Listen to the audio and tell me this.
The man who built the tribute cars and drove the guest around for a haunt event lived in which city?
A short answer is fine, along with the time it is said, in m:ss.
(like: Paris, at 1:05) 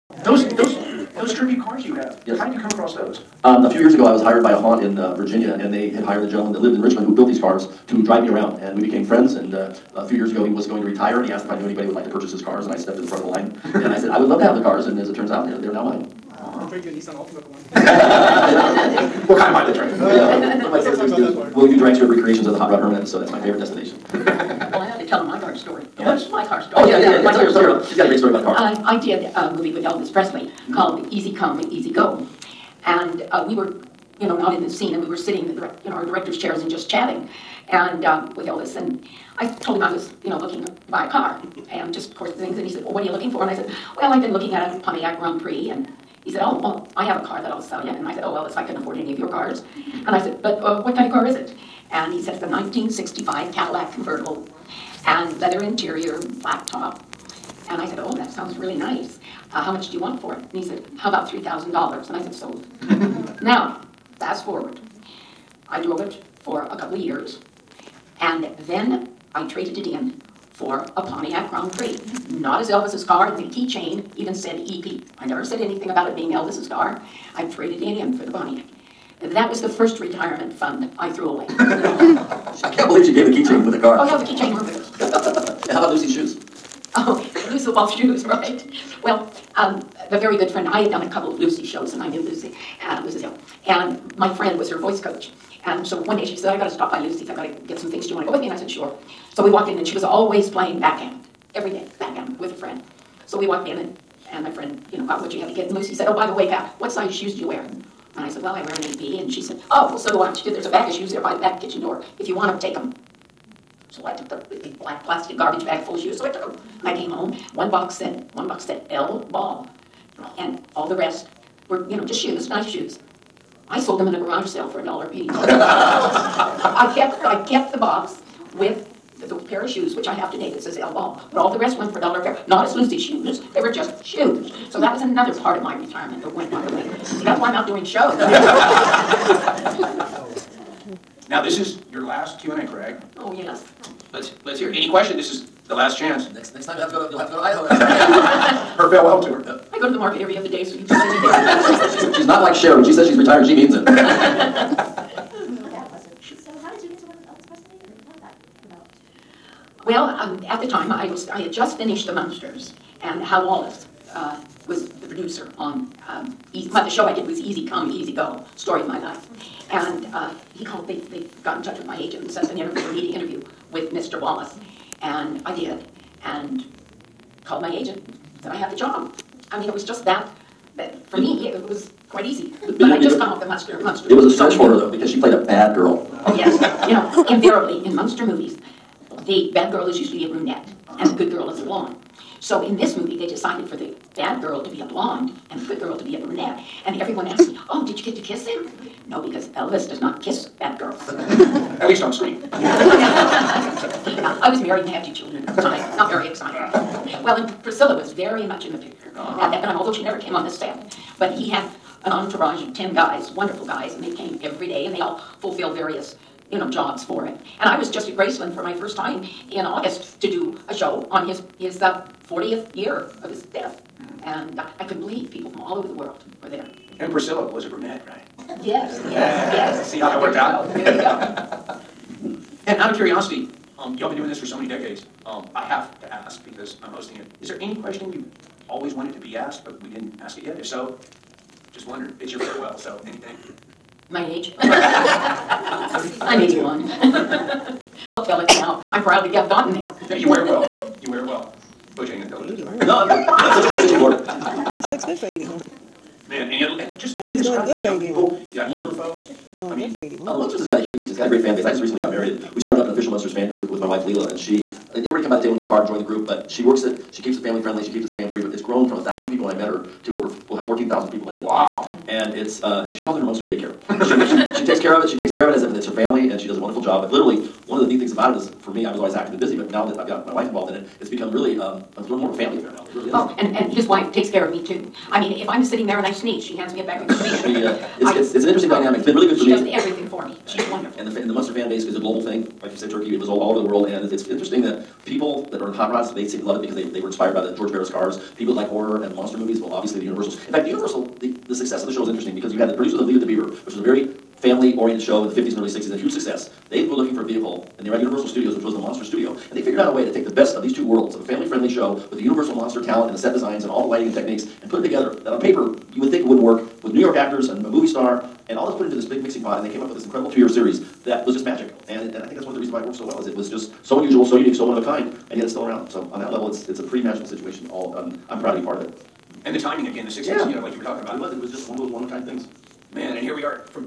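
Richmond, at 0:06.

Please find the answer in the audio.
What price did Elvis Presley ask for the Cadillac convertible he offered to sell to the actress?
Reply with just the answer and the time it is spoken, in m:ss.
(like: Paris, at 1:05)
$3,000, at 1:01.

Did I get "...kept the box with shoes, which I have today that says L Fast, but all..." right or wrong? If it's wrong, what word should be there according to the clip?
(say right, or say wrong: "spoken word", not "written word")
wrong: "Ball", not "Fast".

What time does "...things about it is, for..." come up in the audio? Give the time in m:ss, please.
4:38.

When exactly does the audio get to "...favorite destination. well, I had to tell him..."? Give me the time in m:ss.
0:23.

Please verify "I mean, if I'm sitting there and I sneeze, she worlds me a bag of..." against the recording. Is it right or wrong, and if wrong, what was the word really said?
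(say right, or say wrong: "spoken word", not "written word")
wrong: "hands", not "worlds".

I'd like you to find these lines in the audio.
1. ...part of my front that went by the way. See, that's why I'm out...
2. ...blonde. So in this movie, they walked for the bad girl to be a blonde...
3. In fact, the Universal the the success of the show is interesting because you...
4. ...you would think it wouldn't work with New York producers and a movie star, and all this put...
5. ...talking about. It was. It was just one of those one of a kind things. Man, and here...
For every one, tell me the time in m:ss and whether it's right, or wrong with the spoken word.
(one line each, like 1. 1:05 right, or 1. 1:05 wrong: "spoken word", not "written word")
1. 2:15 wrong: "retirement", not "front"
2. 3:11 wrong: "decided", not "walked"
3. 5:00 right
4. 5:15 wrong: "actors", not "producers"
5. 5:30 right.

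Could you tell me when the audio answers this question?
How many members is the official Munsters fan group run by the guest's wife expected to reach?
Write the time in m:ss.
4:30.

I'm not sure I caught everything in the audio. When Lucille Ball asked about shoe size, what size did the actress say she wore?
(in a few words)
8B.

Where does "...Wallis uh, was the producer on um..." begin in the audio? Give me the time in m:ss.
2:43.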